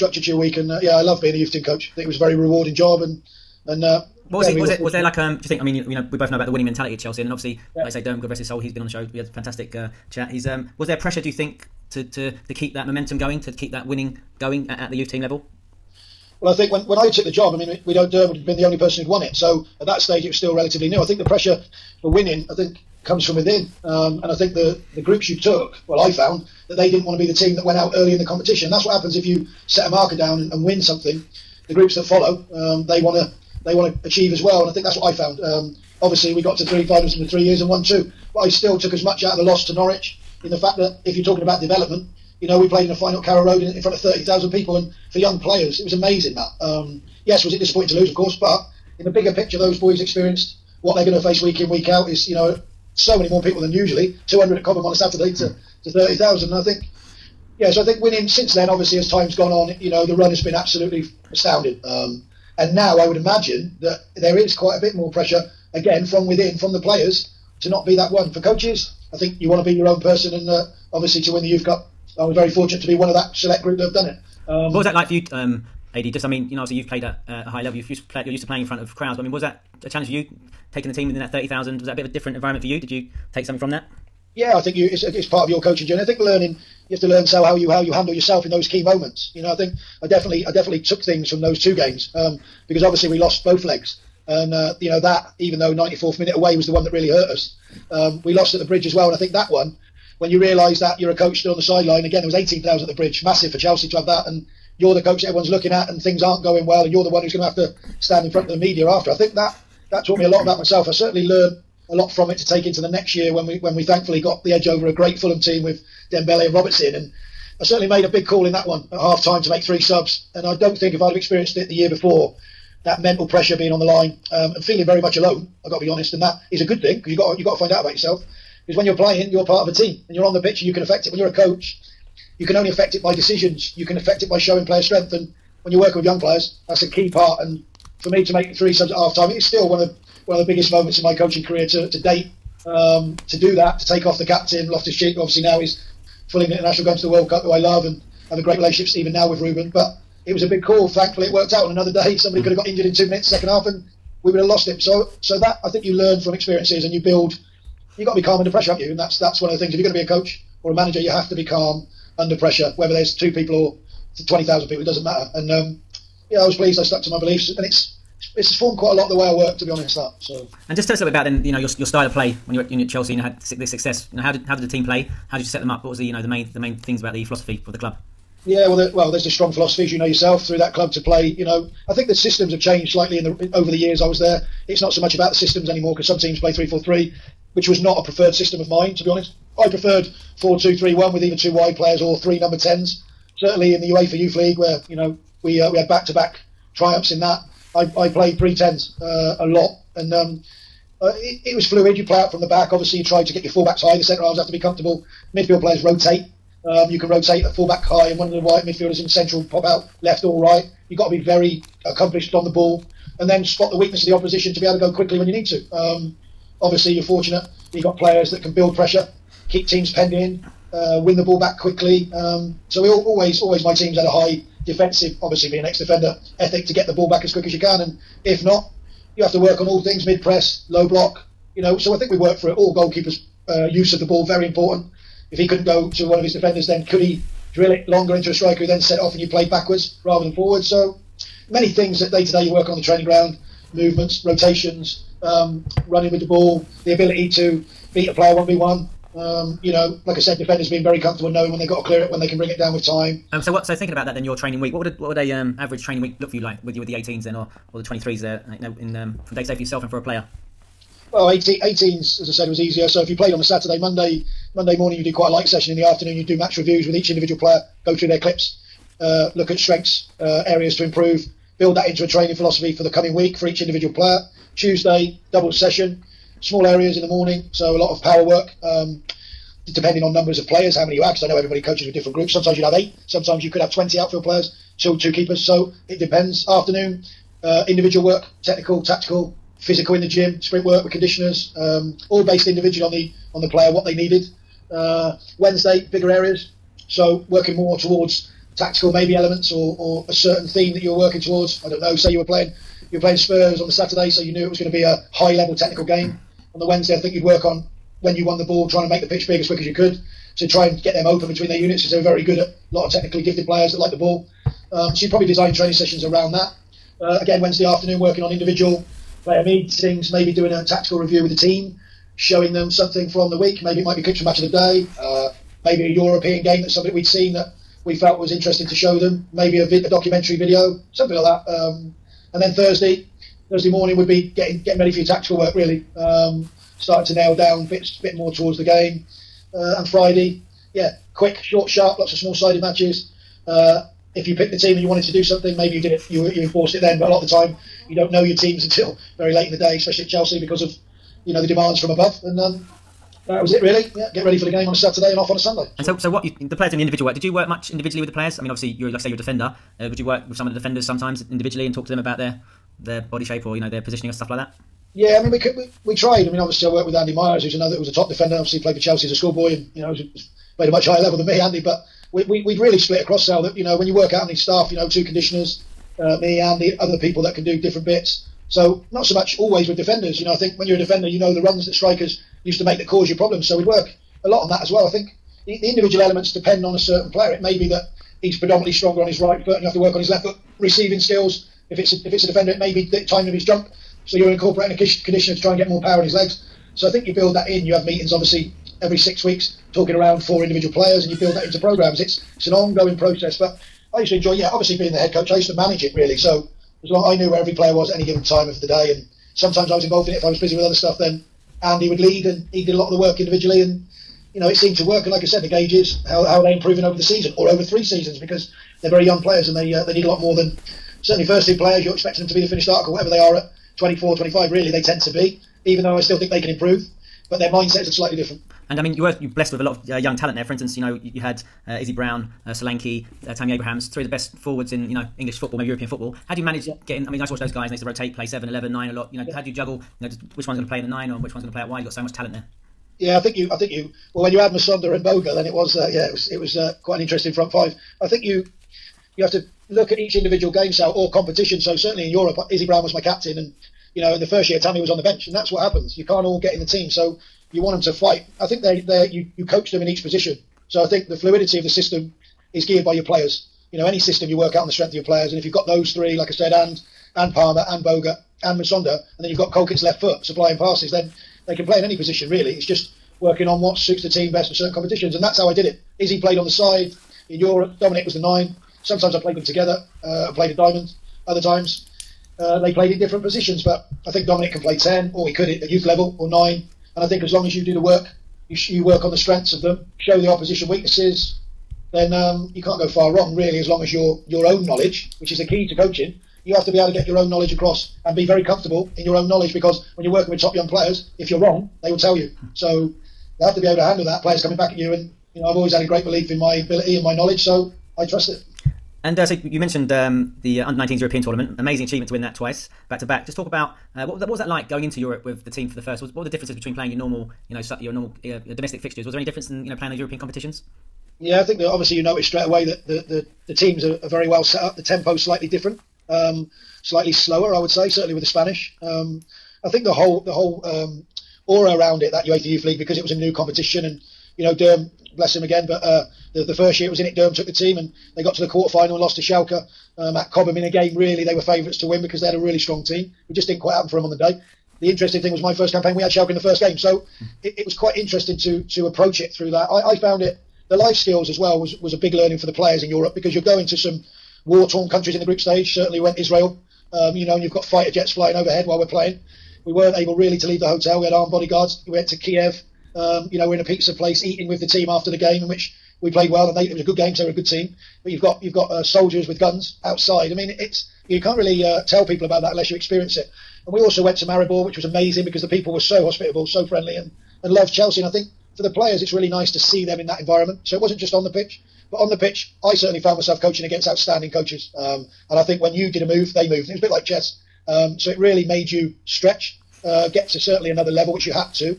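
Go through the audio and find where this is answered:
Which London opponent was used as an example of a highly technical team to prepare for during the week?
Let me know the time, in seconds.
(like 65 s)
303 s.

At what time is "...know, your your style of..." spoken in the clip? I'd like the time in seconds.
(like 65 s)
171 s.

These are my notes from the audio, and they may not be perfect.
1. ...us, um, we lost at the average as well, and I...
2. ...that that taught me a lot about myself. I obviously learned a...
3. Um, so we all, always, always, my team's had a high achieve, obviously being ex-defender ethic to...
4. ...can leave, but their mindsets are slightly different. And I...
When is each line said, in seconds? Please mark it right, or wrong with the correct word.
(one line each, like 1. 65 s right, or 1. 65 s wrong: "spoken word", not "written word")
1. 97 s wrong: "bridge", not "average"
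2. 109 s wrong: "certainly", not "obviously"
3. 222 s wrong: "defensive", not "achieve"
4. 426 s wrong: "improve", not "leave".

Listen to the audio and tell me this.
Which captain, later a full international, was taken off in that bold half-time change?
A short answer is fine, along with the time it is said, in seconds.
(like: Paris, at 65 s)
Loftus Cheek, at 144 s.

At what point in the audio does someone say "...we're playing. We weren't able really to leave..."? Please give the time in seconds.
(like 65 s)
558 s.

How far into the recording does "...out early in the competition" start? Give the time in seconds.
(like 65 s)
27 s.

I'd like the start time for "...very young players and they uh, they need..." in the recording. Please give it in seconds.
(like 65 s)
418 s.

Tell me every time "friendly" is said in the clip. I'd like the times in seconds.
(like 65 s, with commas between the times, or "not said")
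576 s.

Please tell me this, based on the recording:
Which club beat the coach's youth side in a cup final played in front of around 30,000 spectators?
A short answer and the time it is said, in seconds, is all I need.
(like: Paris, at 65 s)
Norwich, at 39 s.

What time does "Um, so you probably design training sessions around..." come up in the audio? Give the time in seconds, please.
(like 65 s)
314 s.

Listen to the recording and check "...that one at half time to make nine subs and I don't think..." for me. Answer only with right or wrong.
wrong.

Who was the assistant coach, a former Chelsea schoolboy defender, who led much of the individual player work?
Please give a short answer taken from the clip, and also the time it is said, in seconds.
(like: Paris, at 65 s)
Andy Myers, at 366 s.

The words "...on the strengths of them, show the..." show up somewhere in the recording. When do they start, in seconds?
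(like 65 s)
489 s.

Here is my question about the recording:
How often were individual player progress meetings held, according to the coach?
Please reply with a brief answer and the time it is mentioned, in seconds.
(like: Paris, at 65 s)
every 6 weeks, at 398 s.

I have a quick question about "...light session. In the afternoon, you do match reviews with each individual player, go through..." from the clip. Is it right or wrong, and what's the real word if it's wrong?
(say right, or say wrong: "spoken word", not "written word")
right.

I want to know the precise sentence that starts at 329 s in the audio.
Maybe a, vi- a documentary video, something like that.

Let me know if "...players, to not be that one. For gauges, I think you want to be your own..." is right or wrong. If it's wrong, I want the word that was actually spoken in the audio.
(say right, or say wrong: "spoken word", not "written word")
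wrong: "coaches", not "gauges".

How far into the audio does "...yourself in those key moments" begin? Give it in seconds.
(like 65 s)
88 s.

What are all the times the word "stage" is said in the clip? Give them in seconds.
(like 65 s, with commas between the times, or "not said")
19 s, 555 s.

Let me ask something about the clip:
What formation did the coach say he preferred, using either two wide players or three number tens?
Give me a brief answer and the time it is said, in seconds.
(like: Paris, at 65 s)
4-2-3-1, at 190 s.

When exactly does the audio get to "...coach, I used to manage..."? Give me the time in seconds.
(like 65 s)
405 s.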